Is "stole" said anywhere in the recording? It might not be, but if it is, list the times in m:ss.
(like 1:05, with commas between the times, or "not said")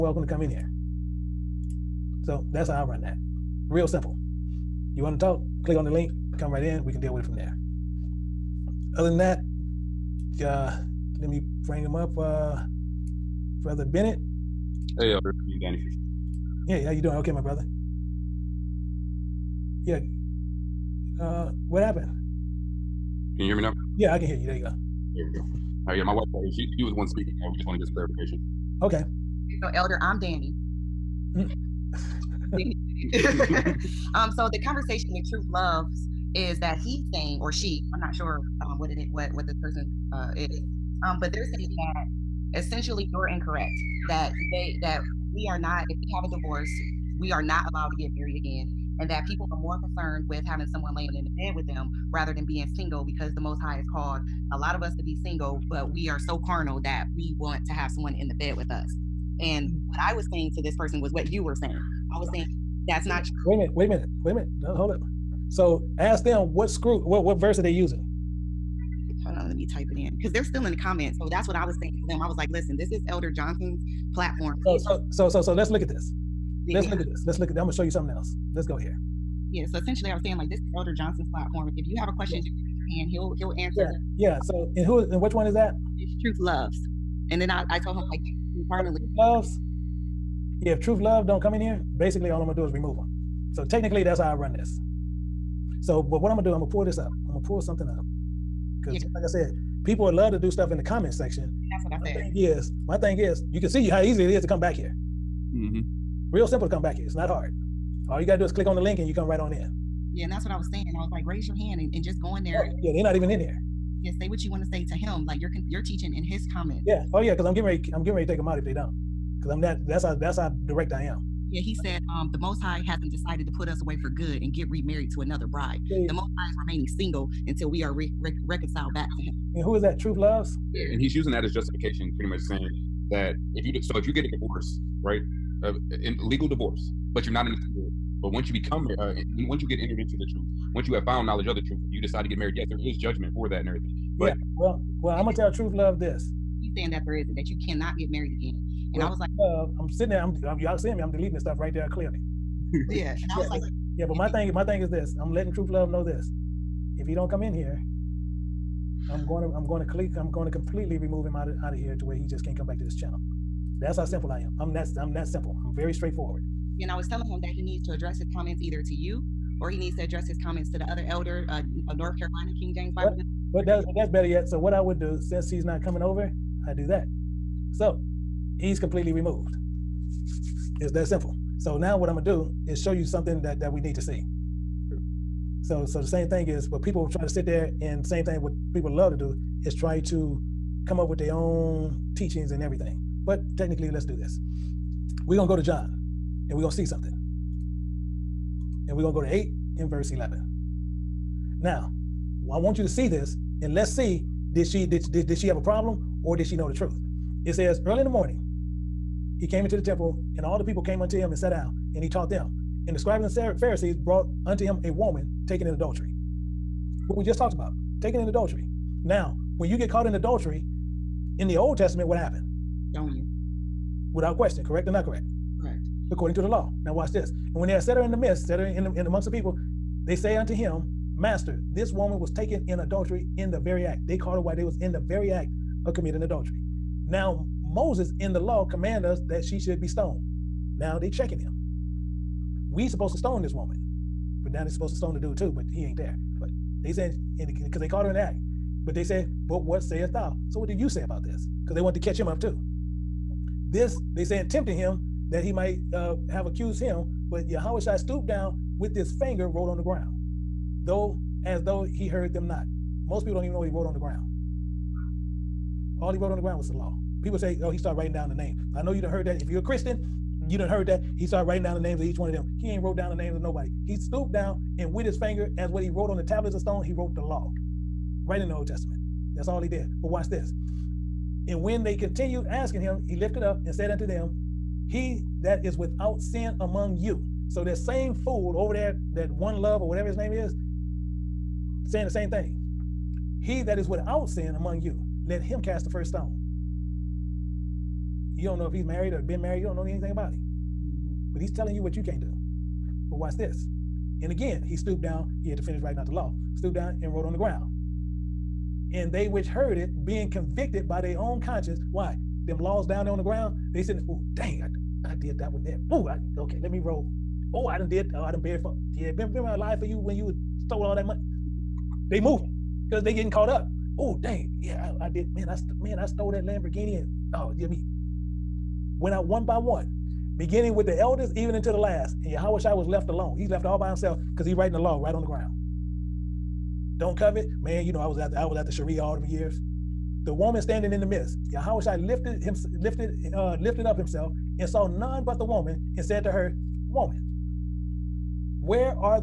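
5:20, 5:26.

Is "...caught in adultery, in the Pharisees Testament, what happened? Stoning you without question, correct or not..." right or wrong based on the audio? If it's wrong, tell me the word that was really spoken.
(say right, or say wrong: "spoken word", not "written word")
wrong: "Old", not "Pharisees".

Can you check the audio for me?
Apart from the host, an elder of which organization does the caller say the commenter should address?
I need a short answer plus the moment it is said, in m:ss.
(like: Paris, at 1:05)
North Carolina King James Bible, at 2:51.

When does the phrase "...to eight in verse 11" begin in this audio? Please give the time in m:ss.
3:19.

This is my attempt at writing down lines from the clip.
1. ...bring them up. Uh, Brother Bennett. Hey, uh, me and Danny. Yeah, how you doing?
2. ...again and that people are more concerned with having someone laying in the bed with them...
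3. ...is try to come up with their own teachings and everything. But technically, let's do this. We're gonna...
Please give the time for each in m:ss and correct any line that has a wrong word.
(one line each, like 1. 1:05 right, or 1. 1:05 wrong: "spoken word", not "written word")
1. 0:11 right
2. 0:48 right
3. 3:09 right.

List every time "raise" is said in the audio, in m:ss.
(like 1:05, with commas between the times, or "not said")
1:22, 1:51.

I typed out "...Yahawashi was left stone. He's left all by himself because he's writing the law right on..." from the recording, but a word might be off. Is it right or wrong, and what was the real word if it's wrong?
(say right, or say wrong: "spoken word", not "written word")
wrong: "alone", not "stone".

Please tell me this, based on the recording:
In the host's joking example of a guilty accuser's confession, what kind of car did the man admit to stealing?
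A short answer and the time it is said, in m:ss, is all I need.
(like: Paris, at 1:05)
Lamborghini, at 5:26.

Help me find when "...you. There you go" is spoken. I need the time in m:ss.
0:24.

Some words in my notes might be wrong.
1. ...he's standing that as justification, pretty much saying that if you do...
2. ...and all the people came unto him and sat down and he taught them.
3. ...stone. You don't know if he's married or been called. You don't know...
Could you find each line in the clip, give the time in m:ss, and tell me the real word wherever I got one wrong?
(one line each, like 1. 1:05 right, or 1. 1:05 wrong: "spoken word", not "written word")
1. 2:10 wrong: "using", not "standing"
2. 3:30 right
3. 4:56 wrong: "married", not "called".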